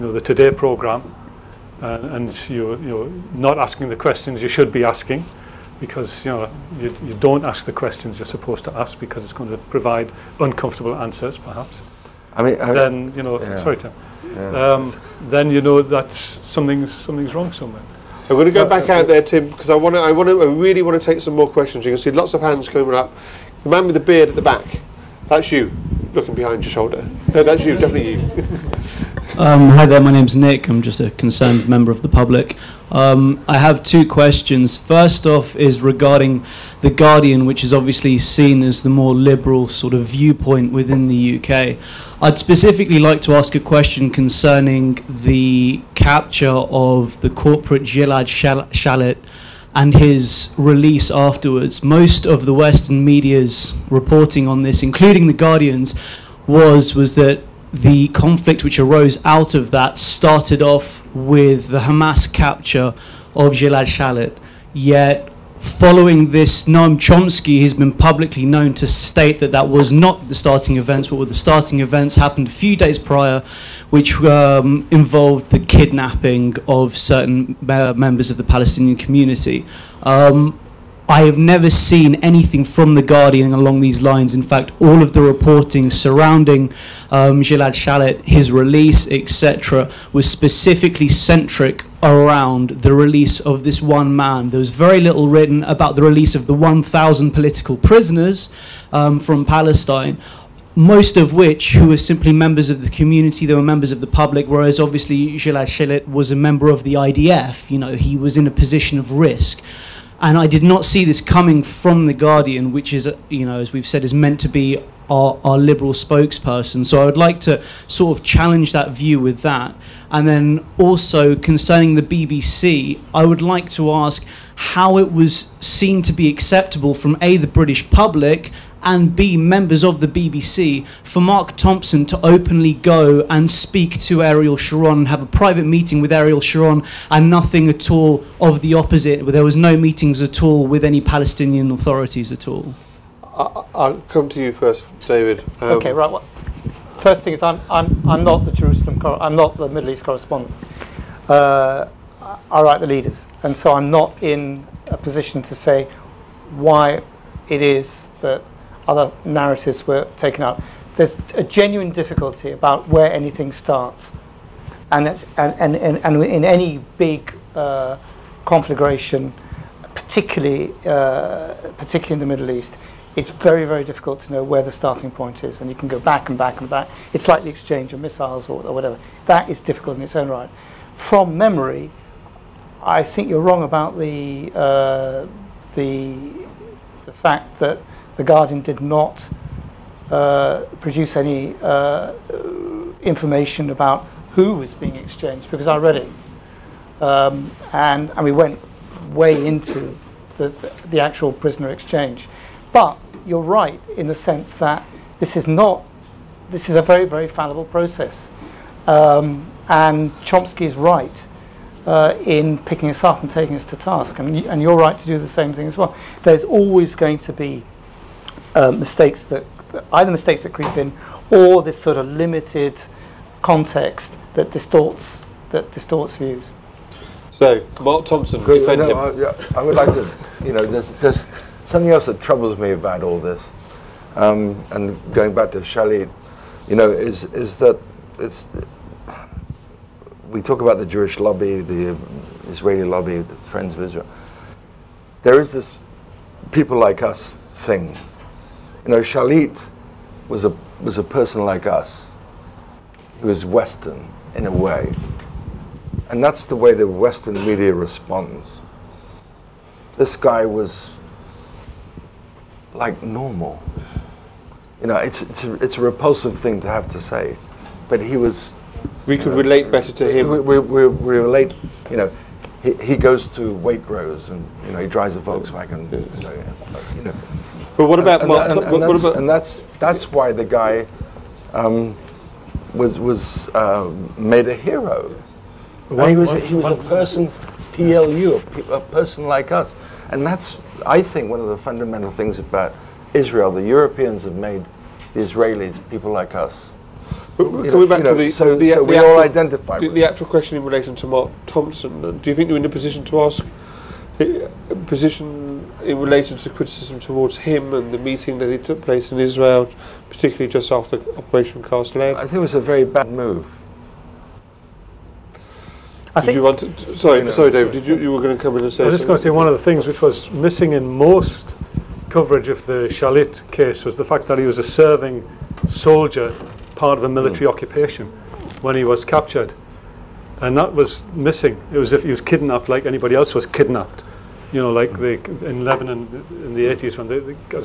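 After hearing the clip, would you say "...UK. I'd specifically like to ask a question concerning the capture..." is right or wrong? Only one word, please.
right.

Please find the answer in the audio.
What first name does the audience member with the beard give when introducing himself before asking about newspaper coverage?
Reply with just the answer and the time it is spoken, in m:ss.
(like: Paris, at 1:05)
Nick, at 0:30.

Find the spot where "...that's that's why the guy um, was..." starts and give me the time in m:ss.
4:39.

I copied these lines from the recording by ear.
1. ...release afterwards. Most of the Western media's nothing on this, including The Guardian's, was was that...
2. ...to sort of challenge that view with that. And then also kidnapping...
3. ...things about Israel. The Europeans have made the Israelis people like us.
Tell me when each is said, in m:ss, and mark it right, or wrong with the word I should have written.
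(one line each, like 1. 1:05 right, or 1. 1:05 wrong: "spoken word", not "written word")
1. 0:50 wrong: "reporting", not "nothing"
2. 1:57 wrong: "concerning", not "kidnapping"
3. 4:52 right.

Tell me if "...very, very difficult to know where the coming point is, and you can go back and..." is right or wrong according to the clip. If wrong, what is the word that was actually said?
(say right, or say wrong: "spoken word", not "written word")
wrong: "starting", not "coming".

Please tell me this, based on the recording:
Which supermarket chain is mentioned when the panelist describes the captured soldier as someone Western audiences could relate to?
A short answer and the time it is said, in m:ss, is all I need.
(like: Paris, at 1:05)
Waitrose, at 4:33.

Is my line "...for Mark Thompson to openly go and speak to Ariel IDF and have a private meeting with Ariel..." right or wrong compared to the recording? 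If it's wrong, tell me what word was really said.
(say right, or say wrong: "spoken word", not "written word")
wrong: "Sharon", not "IDF".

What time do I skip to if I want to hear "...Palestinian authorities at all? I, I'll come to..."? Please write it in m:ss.
2:21.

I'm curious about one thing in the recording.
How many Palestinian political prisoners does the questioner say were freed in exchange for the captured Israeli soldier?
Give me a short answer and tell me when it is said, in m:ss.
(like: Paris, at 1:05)
1,000, at 1:36.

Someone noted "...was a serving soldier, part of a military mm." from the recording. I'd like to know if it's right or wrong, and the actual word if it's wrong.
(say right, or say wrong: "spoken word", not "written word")
right.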